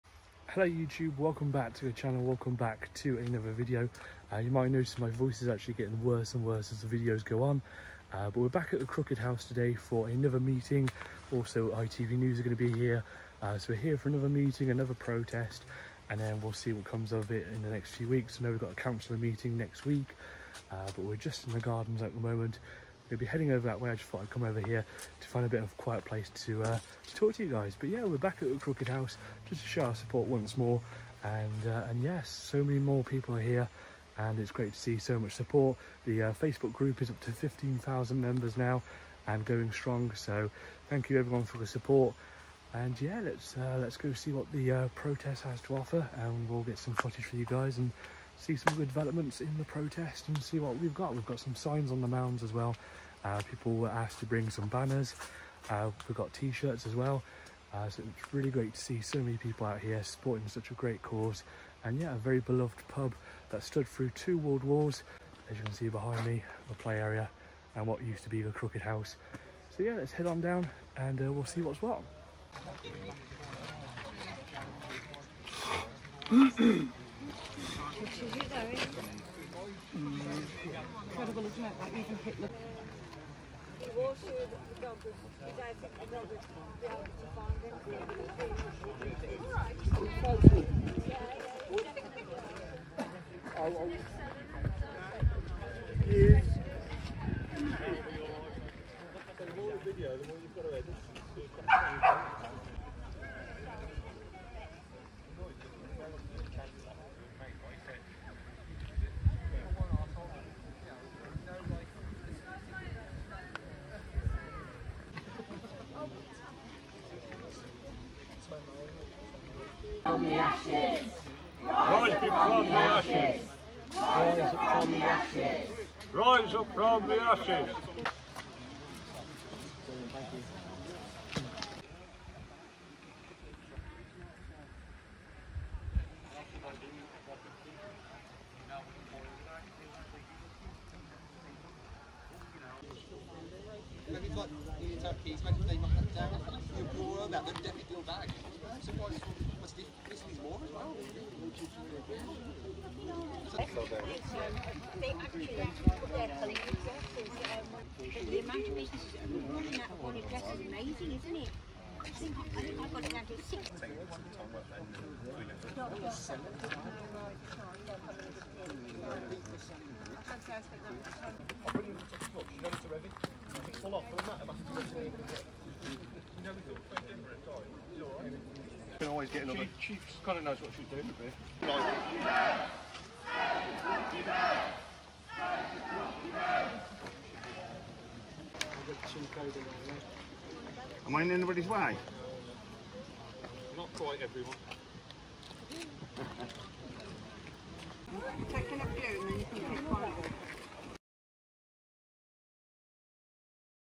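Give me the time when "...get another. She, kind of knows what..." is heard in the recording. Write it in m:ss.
2:59.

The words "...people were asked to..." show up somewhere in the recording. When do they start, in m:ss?
0:53.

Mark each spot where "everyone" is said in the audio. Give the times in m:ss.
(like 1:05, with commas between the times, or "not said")
0:41, 3:14.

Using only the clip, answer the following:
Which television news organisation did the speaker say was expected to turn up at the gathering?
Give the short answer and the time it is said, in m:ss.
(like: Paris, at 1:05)
ITV News, at 0:11.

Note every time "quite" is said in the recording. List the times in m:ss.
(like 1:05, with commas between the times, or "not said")
2:56, 3:13.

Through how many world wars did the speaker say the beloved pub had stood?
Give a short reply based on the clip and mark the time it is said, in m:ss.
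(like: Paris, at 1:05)
2, at 1:04.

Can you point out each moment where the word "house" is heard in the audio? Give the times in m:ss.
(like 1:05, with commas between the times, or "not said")
0:09, 0:28, 1:08.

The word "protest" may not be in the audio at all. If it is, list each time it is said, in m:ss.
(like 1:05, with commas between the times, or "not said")
0:14, 0:44, 0:49.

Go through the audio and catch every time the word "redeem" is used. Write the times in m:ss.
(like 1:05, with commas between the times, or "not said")
not said.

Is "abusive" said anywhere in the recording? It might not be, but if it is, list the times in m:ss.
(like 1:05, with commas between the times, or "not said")
not said.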